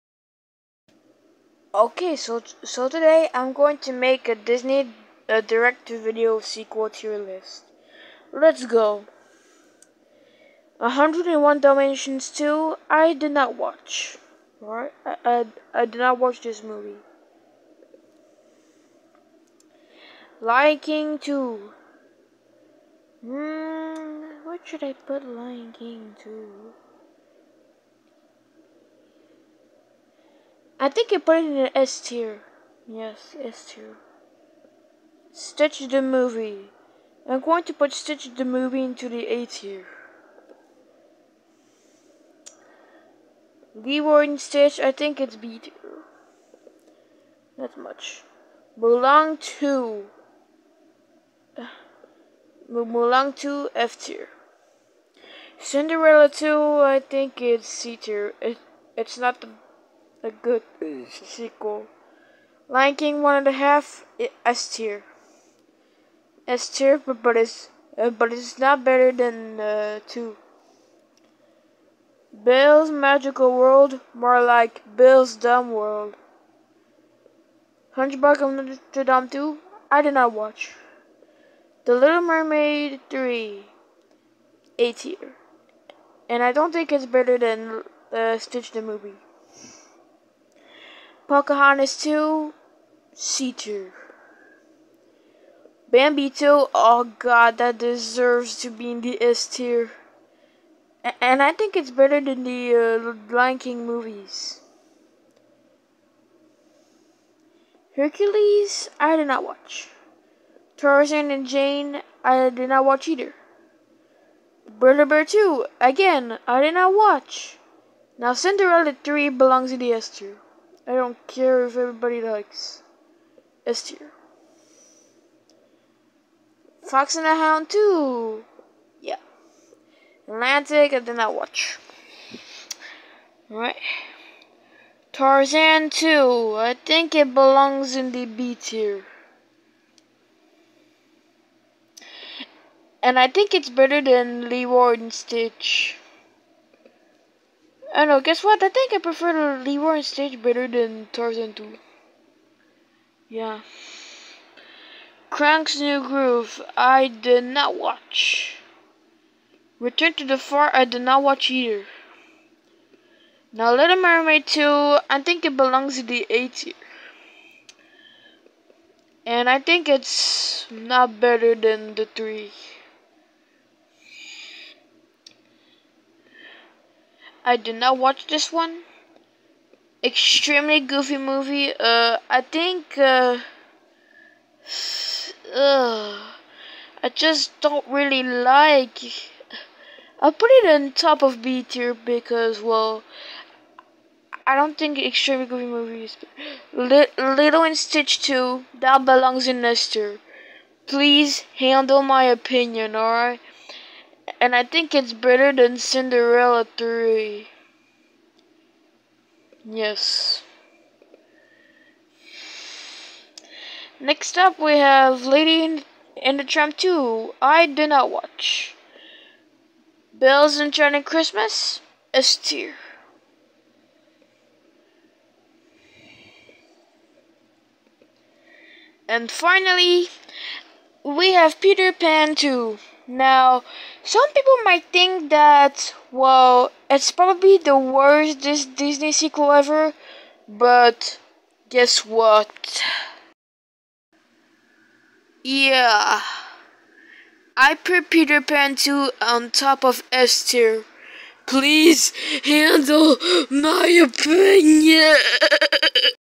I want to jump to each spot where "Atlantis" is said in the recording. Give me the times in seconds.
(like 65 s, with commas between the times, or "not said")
130 s.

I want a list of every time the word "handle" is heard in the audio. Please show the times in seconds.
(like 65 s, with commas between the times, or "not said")
201 s, 252 s.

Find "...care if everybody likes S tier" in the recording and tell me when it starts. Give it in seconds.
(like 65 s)
121 s.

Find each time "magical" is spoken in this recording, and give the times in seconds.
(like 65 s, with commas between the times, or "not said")
72 s.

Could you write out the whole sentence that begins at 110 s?
Tarzan and Jane, I did not watch either.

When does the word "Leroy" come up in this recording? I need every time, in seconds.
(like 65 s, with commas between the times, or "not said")
43 s, 144 s, 149 s.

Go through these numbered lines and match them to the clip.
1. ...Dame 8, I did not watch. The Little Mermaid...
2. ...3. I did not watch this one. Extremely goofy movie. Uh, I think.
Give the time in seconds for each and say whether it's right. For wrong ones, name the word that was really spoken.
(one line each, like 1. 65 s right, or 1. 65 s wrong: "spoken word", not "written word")
1. 79 s wrong: "2", not "8"
2. 172 s right.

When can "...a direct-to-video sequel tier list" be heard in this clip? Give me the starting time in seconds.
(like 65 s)
5 s.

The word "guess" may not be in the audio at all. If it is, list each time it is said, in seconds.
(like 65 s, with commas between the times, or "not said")
148 s, 241 s.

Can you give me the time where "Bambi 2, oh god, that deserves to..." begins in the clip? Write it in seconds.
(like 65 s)
95 s.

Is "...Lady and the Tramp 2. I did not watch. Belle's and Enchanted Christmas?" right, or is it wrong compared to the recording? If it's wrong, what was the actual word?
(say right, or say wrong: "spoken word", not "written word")
right.